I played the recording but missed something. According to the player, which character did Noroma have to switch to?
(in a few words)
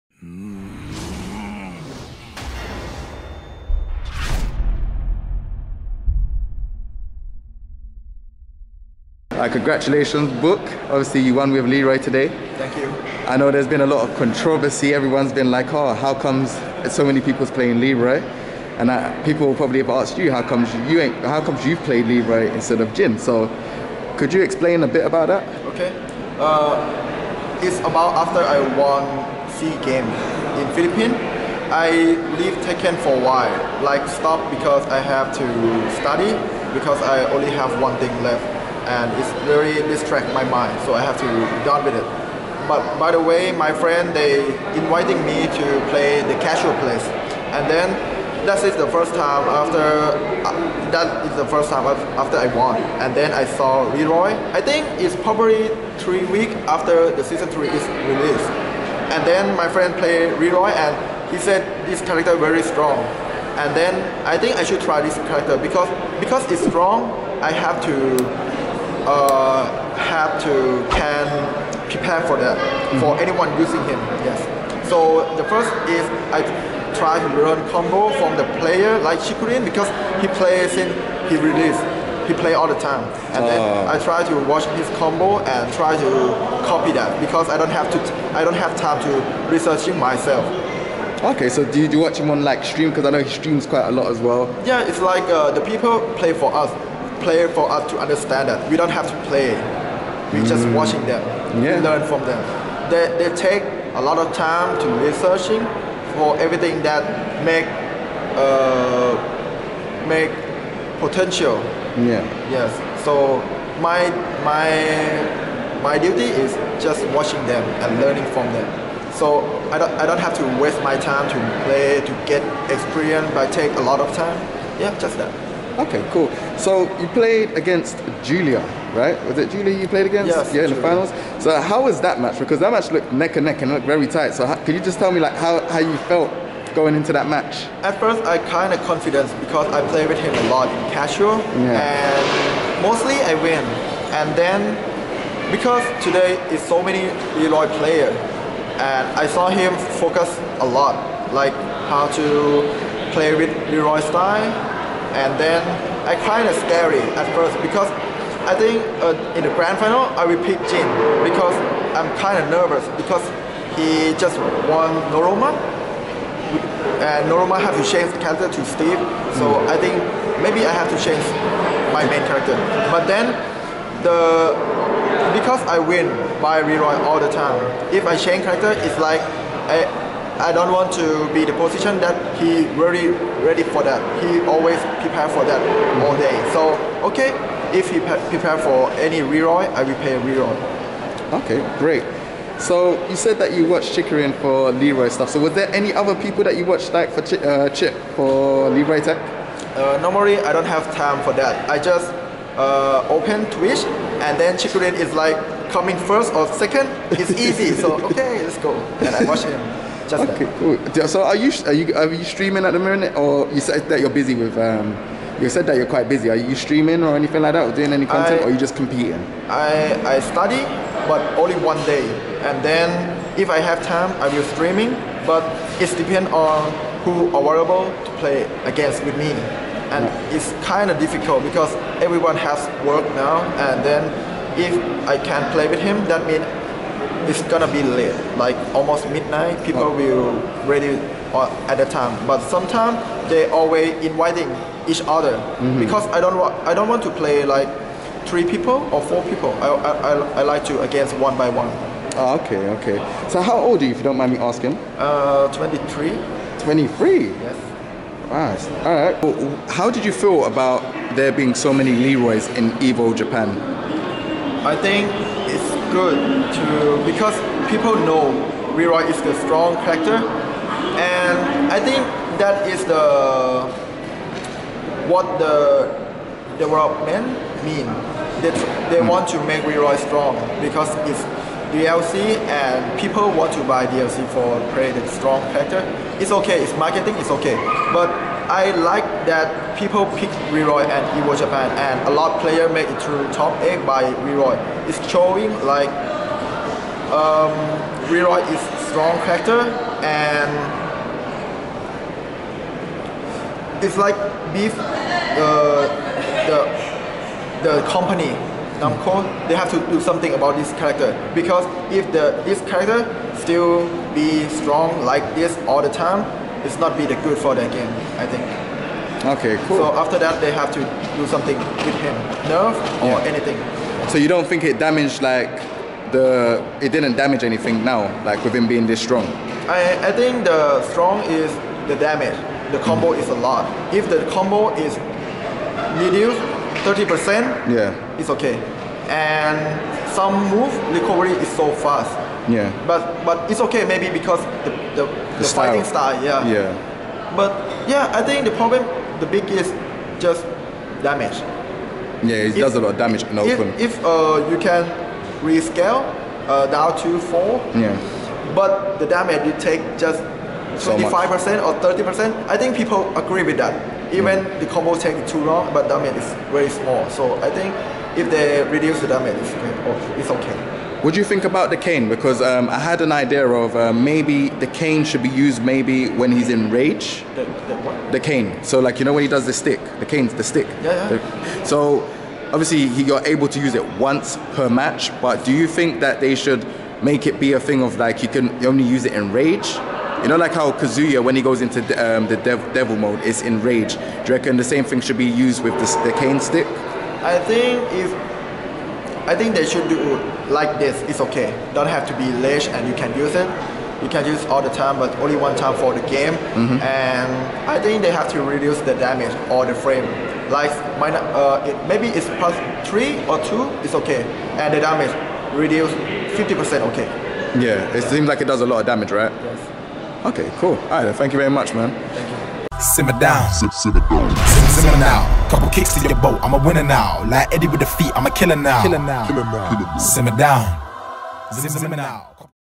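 Steve.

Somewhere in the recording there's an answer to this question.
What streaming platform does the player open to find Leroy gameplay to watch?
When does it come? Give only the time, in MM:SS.
03:23.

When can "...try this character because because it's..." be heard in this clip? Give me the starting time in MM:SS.
01:04.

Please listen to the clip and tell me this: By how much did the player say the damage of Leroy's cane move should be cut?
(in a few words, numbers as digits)
50%.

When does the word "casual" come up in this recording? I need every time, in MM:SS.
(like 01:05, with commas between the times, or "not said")
00:46, 02:20.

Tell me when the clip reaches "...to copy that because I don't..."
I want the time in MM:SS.
01:25.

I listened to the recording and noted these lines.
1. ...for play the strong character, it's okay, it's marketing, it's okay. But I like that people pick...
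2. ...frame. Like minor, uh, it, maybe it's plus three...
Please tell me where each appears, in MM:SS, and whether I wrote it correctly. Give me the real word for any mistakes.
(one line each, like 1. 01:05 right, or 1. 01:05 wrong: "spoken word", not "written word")
1. 04:44 right
2. 06:49 right.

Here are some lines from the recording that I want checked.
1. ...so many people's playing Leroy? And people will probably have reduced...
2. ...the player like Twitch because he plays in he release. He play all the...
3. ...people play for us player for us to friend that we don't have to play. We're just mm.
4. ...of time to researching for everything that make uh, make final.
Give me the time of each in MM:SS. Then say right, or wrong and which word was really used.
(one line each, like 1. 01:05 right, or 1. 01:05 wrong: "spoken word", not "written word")
1. 00:16 wrong: "asked", not "reduced"
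2. 01:18 wrong: "Chikurin", not "Twitch"
3. 01:35 wrong: "understand", not "friend"
4. 01:44 wrong: "potential", not "final".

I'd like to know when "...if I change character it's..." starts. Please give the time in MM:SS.
02:57.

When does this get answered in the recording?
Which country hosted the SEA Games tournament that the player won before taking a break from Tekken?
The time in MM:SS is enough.
00:30.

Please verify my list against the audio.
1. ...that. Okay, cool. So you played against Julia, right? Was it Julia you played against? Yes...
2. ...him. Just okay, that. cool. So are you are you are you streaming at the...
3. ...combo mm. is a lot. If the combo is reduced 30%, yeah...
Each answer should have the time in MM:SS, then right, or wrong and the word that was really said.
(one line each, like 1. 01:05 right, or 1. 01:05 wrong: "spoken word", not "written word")
1. 02:05 right
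2. 03:29 right
3. 05:32 right.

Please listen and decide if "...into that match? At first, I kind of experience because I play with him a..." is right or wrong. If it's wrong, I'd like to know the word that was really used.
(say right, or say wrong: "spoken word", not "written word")
wrong: "confidence", not "experience".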